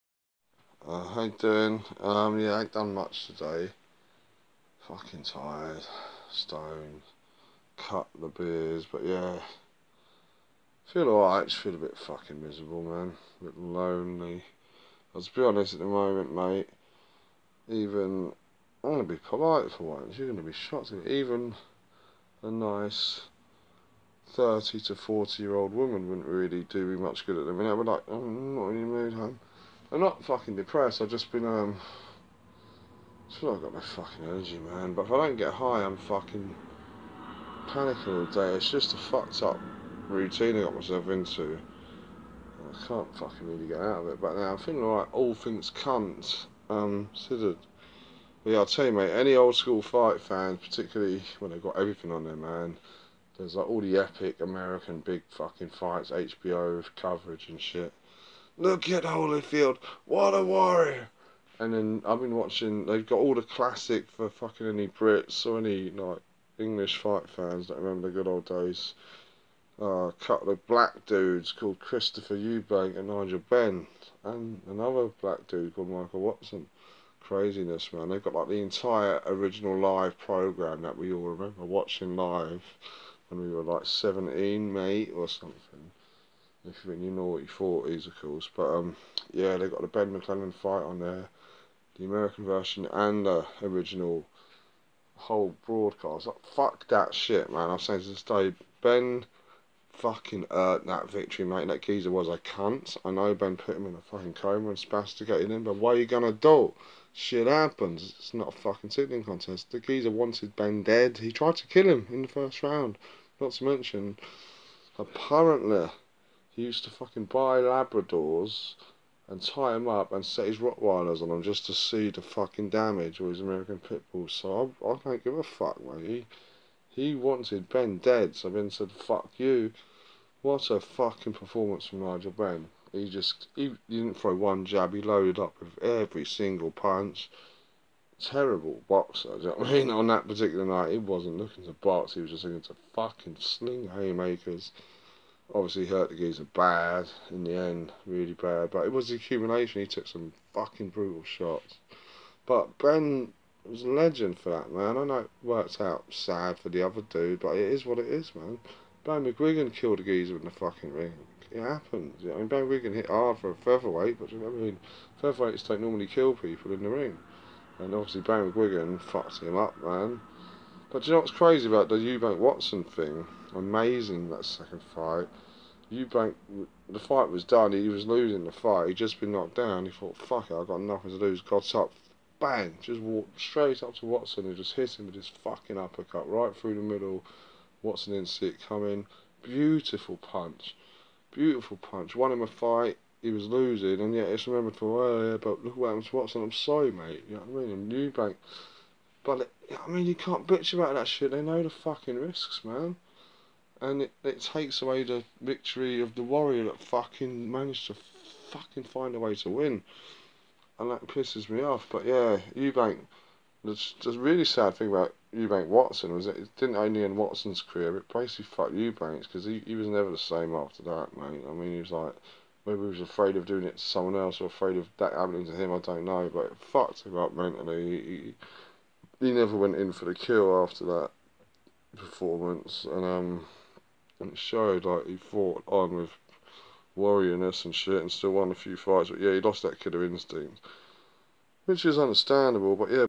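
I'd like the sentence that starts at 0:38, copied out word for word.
It's just a fucked up routine I got myself into.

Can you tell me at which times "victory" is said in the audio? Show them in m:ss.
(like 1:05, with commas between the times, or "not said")
1:41, 3:25.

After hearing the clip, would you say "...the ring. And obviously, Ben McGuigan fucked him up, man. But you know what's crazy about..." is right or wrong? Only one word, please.
right.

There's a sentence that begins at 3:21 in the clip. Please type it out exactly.
They know the fucking risks, man.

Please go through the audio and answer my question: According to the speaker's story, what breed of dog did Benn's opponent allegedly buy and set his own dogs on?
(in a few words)
Labradors.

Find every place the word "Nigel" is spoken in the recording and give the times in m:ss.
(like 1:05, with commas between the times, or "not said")
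1:13, 2:12.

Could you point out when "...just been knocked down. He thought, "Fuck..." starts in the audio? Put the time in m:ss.
2:58.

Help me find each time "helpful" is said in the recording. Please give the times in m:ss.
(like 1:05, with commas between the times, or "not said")
not said.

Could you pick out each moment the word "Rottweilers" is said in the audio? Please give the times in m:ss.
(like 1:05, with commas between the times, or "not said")
2:00.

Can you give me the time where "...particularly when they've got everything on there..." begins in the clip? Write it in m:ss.
0:50.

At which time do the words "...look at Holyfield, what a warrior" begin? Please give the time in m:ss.
0:58.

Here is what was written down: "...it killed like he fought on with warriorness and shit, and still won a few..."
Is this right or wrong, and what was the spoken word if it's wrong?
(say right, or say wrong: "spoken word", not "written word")
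wrong: "showed", not "killed".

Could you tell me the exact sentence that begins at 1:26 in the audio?
If You know what your naughty is, of course.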